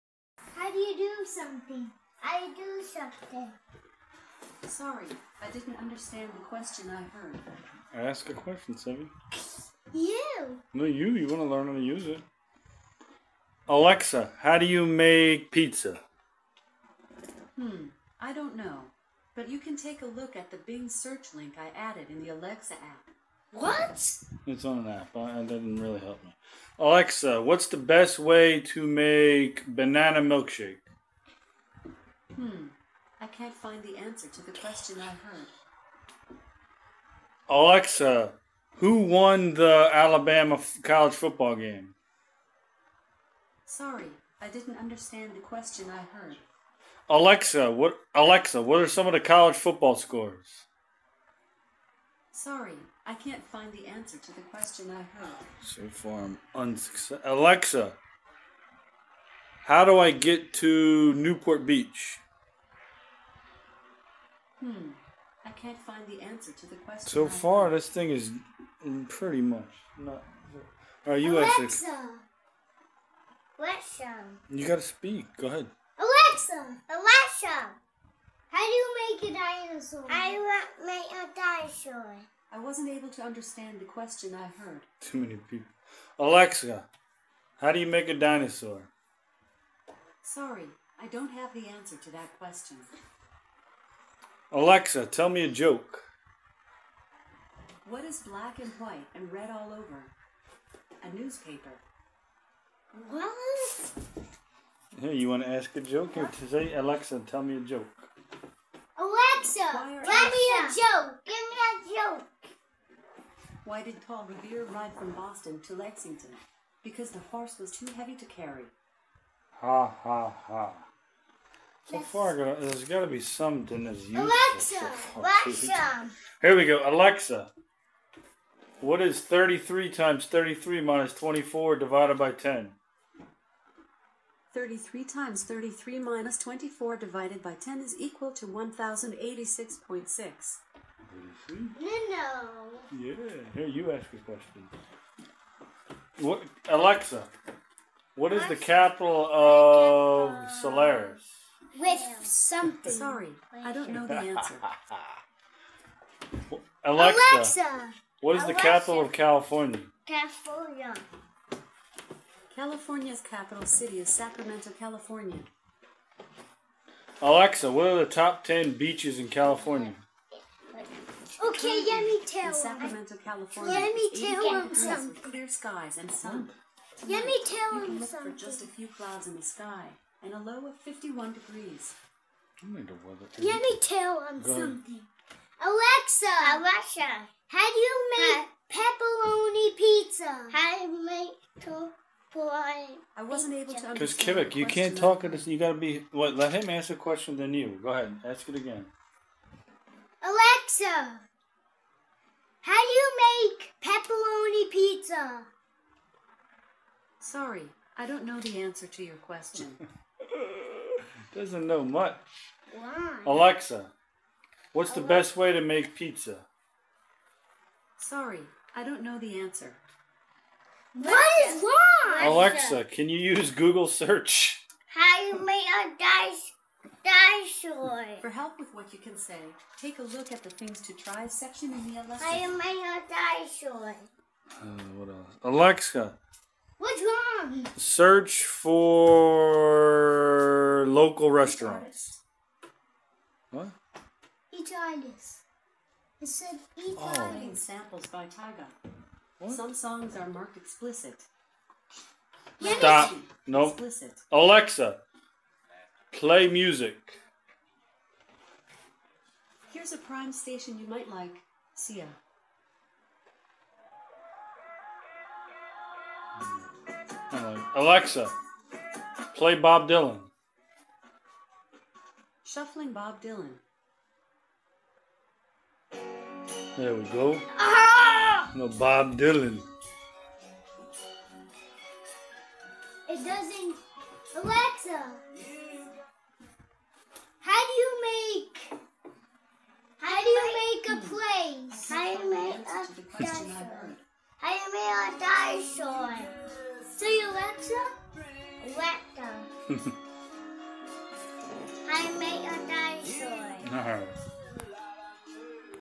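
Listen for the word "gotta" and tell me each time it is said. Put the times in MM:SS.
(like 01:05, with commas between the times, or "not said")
01:14, 03:15.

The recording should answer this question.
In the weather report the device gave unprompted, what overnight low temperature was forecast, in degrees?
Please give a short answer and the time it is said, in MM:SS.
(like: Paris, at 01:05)
51, at 03:00.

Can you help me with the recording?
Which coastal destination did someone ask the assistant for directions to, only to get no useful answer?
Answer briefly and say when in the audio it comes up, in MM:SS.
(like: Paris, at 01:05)
Newport Beach, at 01:01.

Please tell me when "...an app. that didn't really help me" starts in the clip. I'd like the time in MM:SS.
00:24.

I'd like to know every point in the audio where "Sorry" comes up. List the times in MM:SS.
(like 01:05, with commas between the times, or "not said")
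00:04, 00:43, 00:52, 01:30, 02:32, 03:27, 03:37.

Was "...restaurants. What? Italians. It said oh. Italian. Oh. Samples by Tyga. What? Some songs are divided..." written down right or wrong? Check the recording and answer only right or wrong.
wrong.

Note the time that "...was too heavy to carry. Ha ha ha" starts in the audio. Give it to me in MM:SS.
01:57.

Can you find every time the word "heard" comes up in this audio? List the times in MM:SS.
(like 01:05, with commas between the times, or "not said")
00:07, 00:35, 00:46, 00:55, 01:24.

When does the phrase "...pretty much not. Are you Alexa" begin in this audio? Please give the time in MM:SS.
01:09.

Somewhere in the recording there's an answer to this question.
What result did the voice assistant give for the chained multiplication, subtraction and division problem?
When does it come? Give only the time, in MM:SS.
02:18.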